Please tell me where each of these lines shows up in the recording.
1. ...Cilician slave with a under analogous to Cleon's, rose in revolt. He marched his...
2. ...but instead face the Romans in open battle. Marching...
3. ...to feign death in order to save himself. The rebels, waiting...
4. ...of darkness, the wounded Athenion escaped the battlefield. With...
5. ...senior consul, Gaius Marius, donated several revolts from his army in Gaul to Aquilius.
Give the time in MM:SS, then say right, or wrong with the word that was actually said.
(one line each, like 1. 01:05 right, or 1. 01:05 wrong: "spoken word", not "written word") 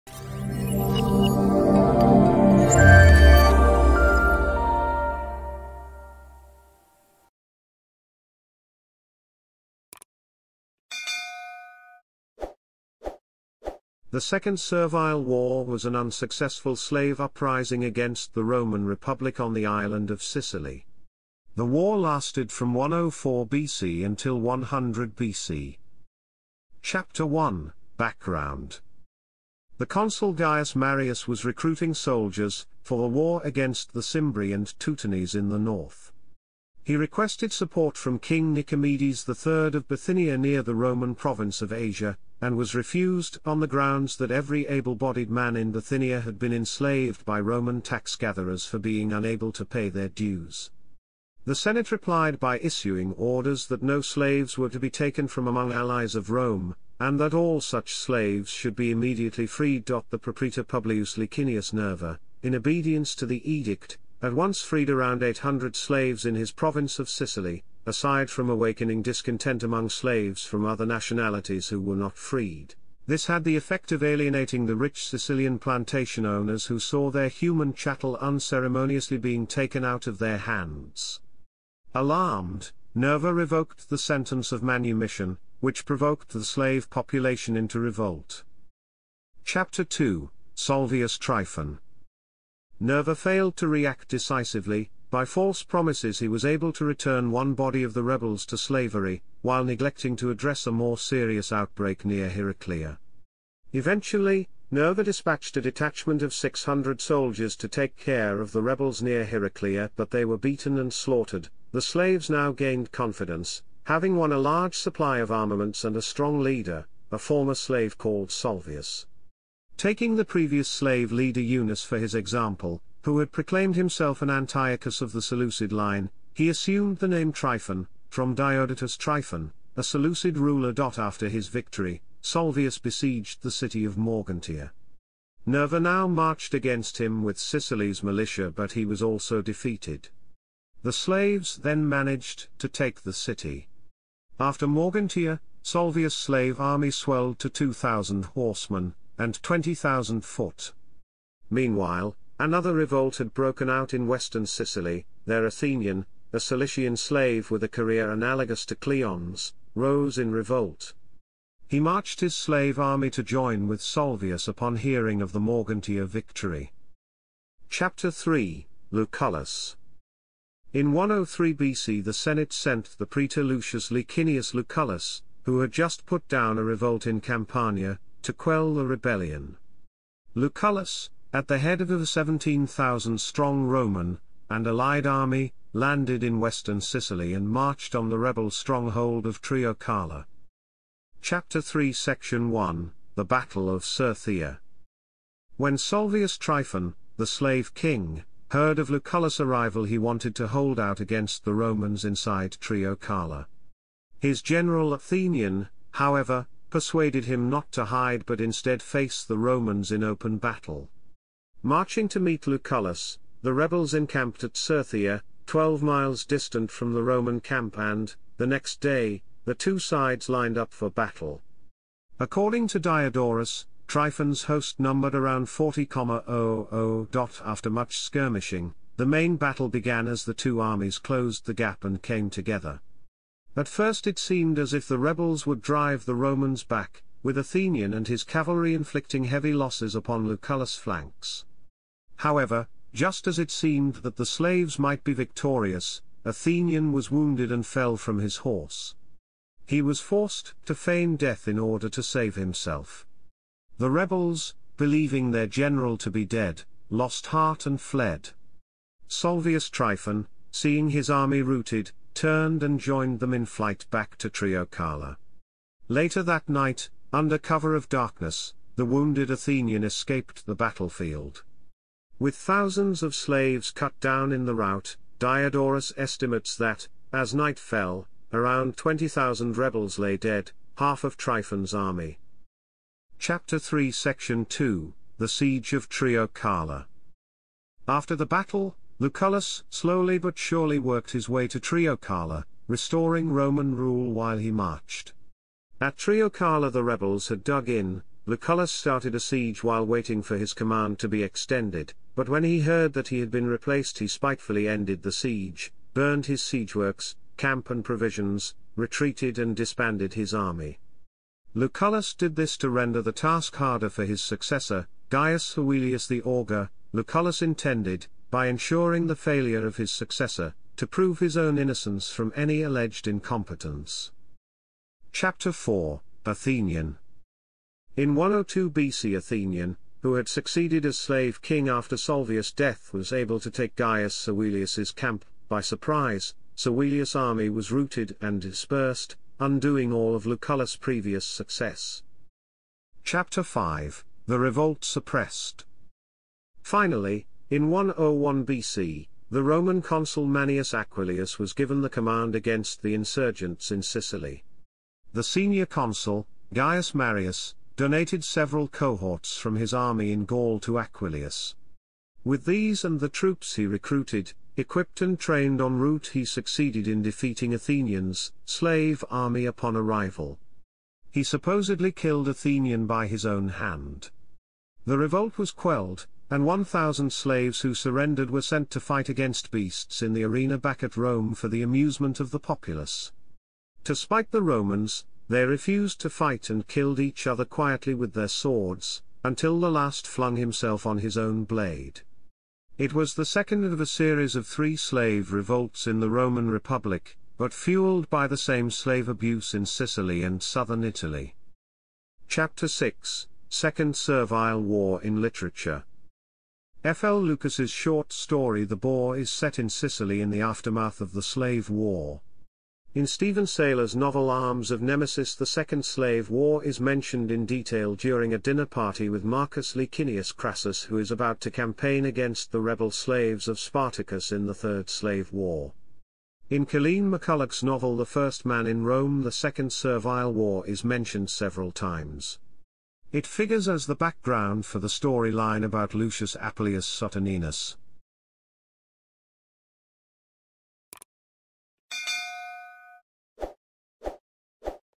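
1. 02:36 wrong: "career", not "under"
2. 03:28 right
3. 04:10 wrong: "believing", not "waiting"
4. 04:27 right
5. 05:55 wrong: "cohorts", not "revolts".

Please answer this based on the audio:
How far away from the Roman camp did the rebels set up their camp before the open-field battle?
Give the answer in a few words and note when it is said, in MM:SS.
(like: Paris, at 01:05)
twelve miles, at 03:35.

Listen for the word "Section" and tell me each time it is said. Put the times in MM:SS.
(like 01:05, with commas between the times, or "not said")
03:11, 04:43.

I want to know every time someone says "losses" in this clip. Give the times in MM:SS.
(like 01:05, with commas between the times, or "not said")
03:59.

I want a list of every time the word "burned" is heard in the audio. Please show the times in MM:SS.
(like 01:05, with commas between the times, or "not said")
05:05.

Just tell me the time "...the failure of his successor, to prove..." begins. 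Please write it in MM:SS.
05:19.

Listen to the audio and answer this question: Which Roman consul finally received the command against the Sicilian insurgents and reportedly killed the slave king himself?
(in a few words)
Manius Aquilius.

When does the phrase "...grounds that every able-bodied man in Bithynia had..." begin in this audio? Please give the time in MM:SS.
00:43.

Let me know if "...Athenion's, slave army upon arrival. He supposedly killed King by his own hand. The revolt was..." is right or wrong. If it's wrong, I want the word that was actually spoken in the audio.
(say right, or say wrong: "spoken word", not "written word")
wrong: "Athenion", not "King".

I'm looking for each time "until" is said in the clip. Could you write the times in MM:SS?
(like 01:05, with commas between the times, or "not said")
00:24, 06:29.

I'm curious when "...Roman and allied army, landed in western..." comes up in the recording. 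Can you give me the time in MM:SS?
03:03.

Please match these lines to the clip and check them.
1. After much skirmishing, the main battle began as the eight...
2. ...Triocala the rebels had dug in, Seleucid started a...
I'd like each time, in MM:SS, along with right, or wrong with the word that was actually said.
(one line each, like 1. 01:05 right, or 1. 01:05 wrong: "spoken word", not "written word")
1. 03:47 wrong: "two", not "eight"
2. 04:55 wrong: "Lucullus", not "Seleucid".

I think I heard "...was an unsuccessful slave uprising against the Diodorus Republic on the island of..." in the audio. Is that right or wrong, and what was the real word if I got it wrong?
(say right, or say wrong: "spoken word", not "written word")
wrong: "Roman", not "Diodorus".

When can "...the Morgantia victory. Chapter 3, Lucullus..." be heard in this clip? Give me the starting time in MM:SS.
02:45.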